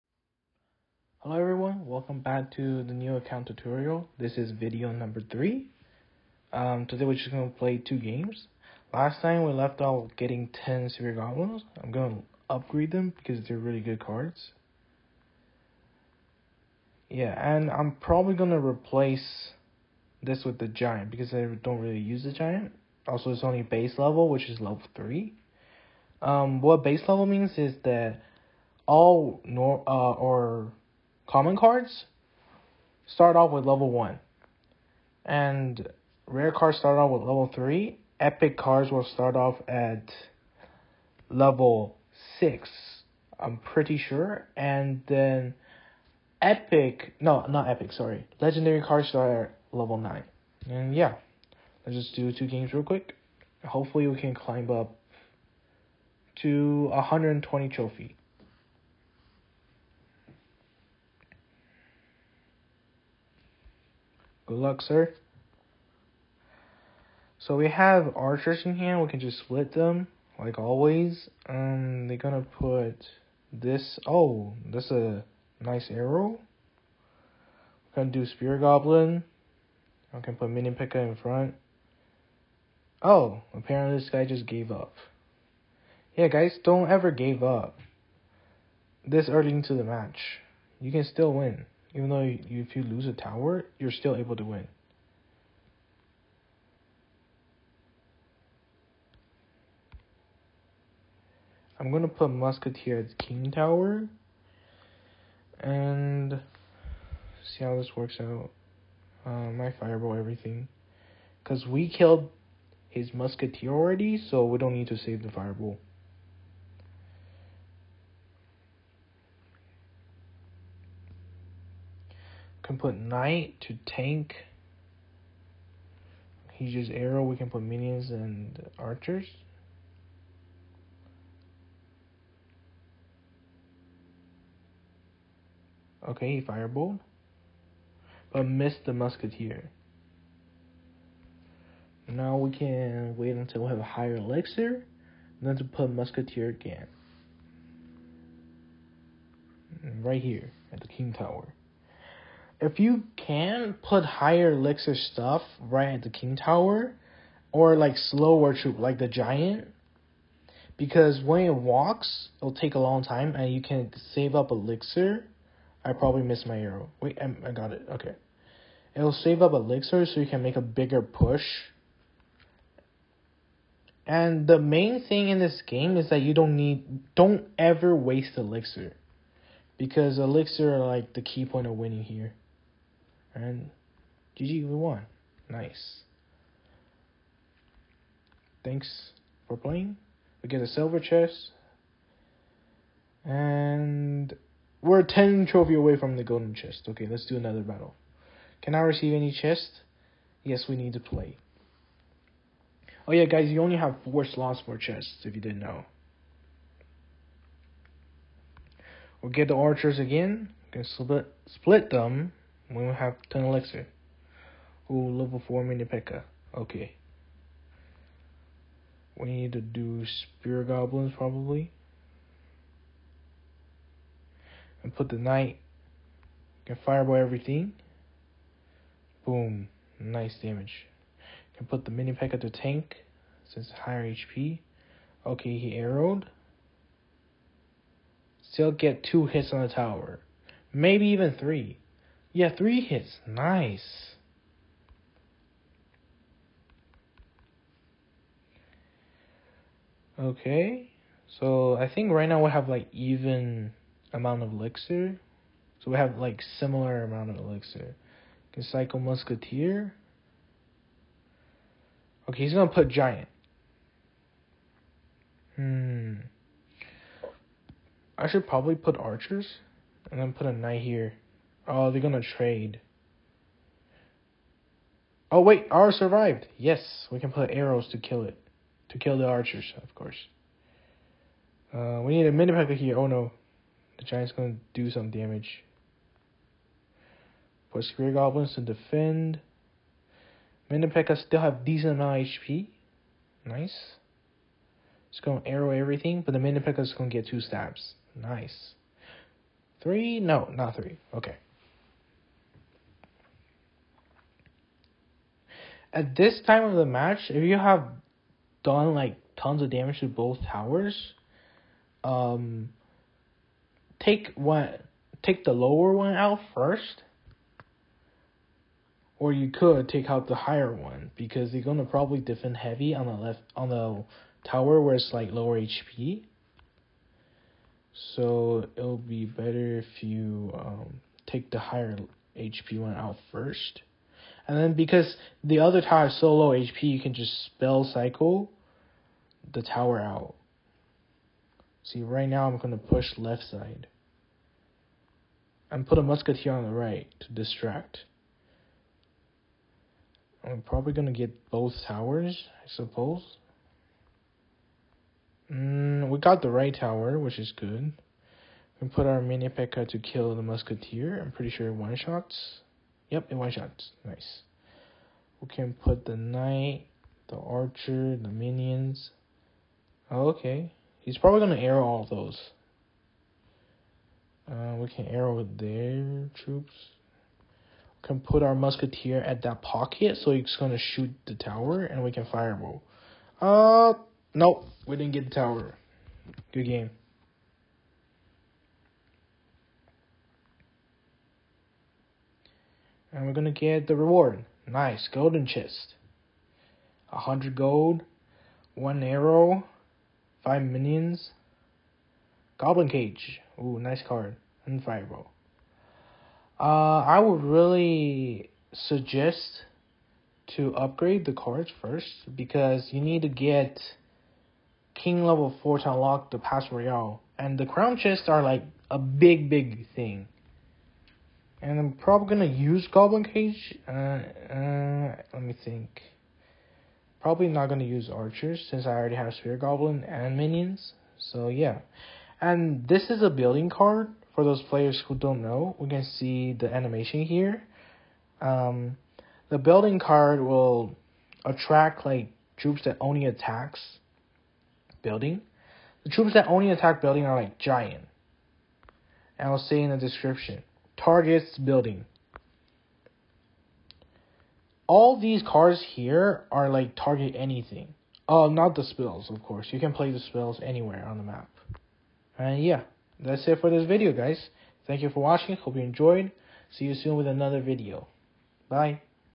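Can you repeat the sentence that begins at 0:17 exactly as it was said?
Yeah, and I'm probably going to replace this with the Giant because I don't really use the Giant.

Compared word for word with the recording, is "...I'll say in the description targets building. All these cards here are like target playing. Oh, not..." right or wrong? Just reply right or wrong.
wrong.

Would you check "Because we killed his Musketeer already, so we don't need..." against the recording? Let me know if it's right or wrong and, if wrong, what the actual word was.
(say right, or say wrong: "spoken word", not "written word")
right.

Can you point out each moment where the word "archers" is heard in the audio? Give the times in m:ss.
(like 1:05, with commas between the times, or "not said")
1:08, 2:08, 3:29, 4:28, 4:39, 6:07, 7:08.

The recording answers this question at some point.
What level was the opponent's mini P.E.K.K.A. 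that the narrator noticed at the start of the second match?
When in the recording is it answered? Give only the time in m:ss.
3:35.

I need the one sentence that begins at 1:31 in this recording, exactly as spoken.
Even though you, if you lose a tower, you're still able to win.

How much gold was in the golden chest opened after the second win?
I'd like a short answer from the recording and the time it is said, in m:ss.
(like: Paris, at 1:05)
100, at 6:37.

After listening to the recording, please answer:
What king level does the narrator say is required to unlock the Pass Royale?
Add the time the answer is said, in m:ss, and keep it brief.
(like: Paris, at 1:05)
4, at 6:54.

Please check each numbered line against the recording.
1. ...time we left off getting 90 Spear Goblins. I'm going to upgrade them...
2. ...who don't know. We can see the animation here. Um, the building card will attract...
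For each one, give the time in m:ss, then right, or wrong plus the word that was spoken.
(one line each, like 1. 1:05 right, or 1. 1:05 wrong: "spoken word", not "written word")
1. 0:09 wrong: "10", not "90"
2. 7:15 right.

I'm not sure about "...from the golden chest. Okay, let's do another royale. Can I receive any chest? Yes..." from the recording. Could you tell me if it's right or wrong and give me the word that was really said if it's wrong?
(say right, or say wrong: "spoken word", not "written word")
wrong: "battle", not "royale".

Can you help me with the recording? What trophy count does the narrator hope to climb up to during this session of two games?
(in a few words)
120.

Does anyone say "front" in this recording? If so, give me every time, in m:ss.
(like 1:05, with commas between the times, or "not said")
1:21.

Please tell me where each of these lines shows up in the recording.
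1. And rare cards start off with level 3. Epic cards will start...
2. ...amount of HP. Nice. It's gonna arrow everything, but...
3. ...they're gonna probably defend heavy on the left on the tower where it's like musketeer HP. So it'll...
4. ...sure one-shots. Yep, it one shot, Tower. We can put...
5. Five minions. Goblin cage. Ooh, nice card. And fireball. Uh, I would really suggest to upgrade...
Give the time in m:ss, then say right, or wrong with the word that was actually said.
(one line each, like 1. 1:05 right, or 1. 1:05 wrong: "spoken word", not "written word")
1. 0:35 right
2. 4:51 right
3. 5:21 wrong: "lower", not "musketeer"
4. 6:01 wrong: "Nice", not "Tower"
5. 6:40 right.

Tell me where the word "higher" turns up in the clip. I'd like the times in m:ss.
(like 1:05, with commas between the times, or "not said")
2:23, 2:34, 3:53, 5:20, 5:31.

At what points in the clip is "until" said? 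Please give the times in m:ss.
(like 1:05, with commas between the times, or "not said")
2:23.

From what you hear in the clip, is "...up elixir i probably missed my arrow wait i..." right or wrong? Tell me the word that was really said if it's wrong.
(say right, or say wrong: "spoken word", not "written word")
right.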